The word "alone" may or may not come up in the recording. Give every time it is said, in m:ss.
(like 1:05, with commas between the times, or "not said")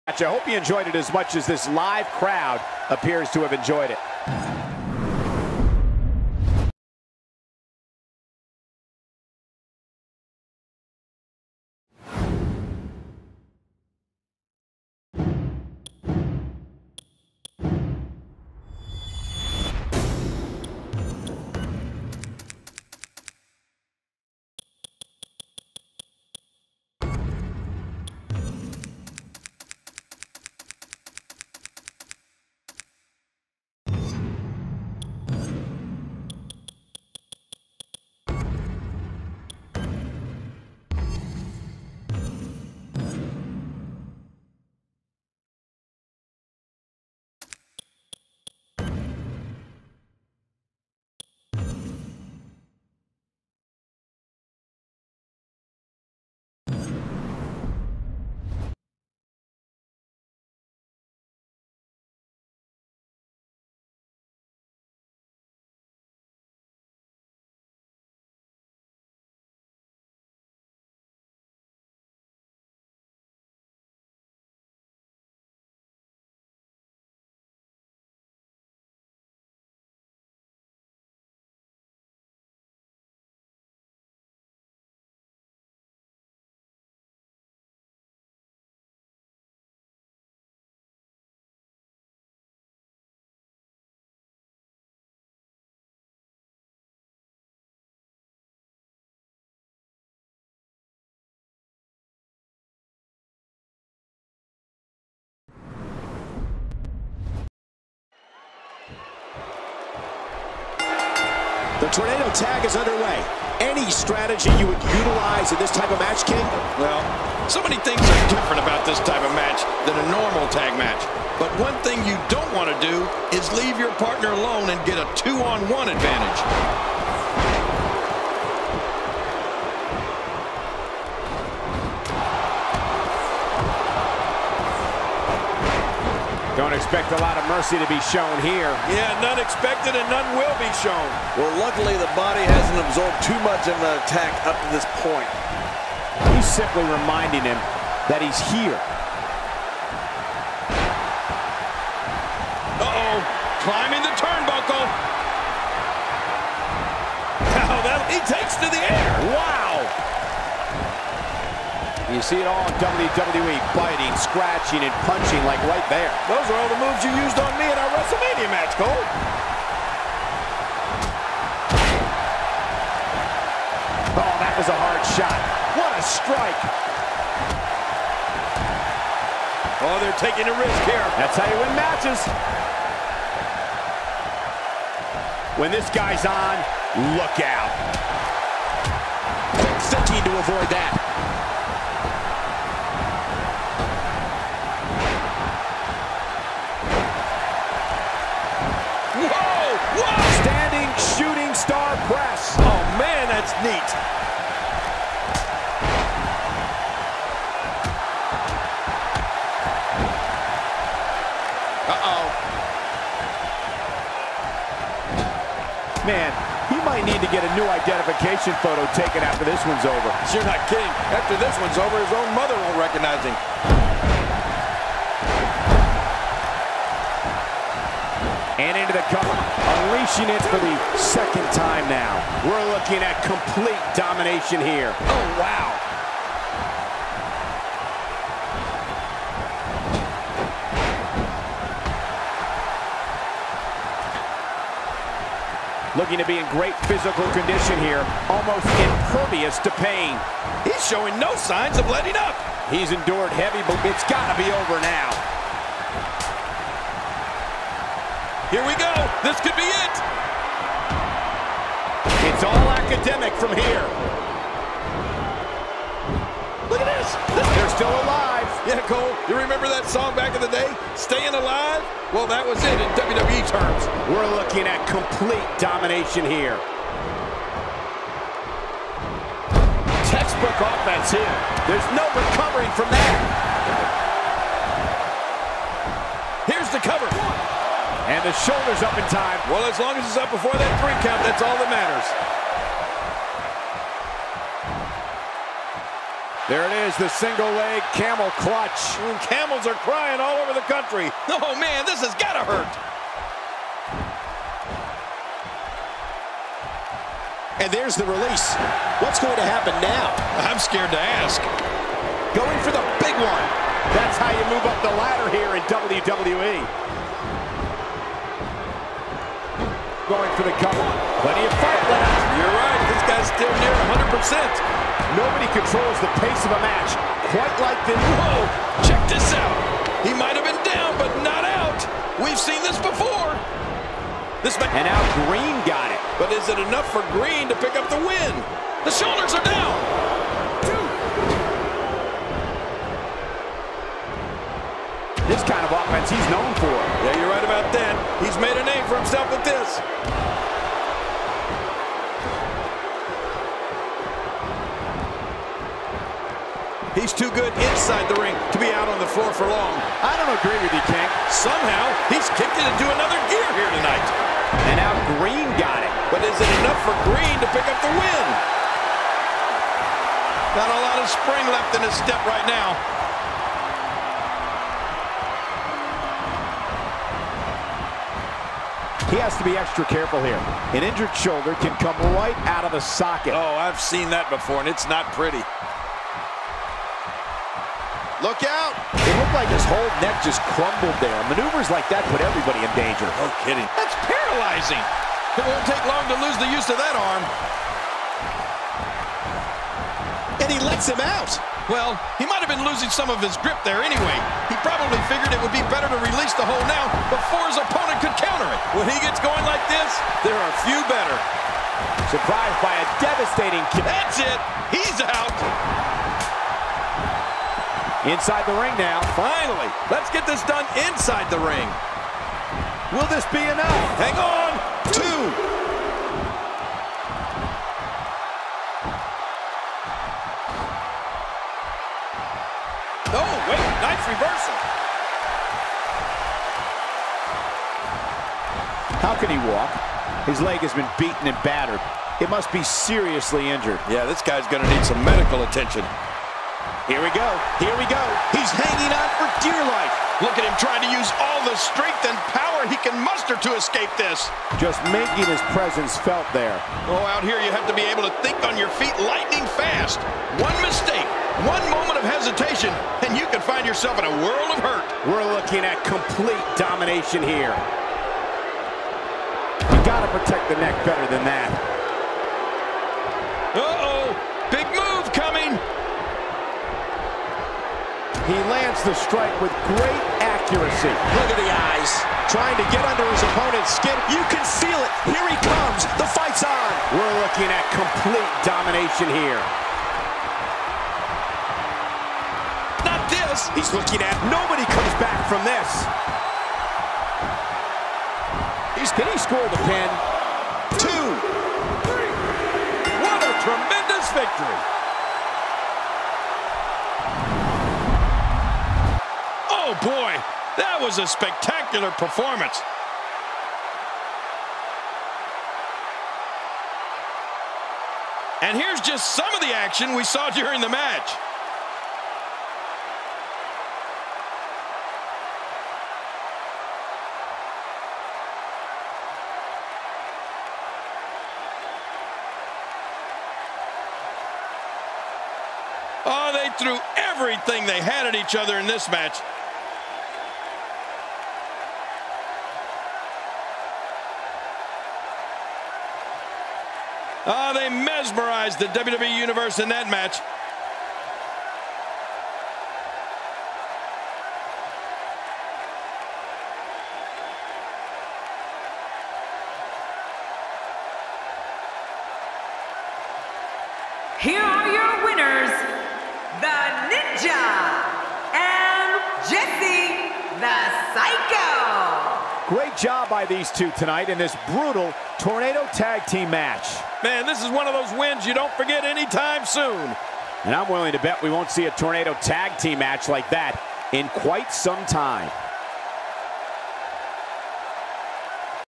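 2:04.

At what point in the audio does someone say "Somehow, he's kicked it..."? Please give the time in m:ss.
6:01.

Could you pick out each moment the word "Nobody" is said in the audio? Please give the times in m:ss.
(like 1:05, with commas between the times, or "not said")
5:25, 8:14.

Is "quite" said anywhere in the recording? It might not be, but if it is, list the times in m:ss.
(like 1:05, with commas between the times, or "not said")
5:27, 9:44.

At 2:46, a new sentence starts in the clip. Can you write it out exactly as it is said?
Those are all the moves you used on me in our WrestleMania match, Cole.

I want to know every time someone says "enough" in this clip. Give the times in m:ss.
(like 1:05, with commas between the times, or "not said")
5:36, 6:06, 7:03.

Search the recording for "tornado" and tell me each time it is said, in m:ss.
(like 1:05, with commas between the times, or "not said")
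1:51, 9:35, 9:41.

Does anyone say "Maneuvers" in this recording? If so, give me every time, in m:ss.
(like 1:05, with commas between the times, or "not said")
6:31.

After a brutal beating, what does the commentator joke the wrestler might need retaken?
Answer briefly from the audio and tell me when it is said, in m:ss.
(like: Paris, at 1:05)
identification photo, at 3:37.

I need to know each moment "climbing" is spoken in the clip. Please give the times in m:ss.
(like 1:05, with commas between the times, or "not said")
2:33.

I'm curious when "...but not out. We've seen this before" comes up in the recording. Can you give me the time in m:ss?
5:30.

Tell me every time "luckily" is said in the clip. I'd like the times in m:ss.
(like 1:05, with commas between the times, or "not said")
2:21.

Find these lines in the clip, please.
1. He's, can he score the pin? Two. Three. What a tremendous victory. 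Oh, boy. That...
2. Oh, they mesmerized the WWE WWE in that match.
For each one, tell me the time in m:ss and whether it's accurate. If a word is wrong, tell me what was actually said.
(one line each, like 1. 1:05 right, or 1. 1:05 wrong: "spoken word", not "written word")
1. 8:18 right
2. 9:07 wrong: "Universe", not "WWE".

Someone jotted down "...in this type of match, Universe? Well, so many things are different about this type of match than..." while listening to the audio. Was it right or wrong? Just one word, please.
wrong.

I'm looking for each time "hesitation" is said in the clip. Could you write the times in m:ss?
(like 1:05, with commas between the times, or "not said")
7:42.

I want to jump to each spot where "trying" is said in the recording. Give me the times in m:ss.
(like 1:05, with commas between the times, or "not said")
7:30, 8:02.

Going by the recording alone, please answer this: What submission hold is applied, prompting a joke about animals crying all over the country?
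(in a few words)
single leg camel clutch.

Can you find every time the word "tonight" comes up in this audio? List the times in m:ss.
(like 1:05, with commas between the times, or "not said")
6:03, 9:33.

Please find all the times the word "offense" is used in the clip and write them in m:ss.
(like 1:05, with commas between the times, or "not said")
4:40, 5:45.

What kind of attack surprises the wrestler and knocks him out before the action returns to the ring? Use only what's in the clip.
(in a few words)
devastating kick.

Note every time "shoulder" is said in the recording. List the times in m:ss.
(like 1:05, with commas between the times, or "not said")
4:48, 5:38, 6:21.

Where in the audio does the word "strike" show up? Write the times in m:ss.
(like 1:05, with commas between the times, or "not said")
2:56, 7:58.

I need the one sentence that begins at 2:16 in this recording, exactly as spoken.
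Don't expect a lot of mercy to be shown here.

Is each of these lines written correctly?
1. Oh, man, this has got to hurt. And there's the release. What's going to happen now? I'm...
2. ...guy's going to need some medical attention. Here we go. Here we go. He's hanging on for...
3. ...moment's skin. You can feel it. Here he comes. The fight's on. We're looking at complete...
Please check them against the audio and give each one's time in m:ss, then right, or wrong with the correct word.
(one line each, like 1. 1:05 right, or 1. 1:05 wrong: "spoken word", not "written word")
1. 5:01 right
2. 7:24 right
3. 8:03 wrong: "opponent", not "moment".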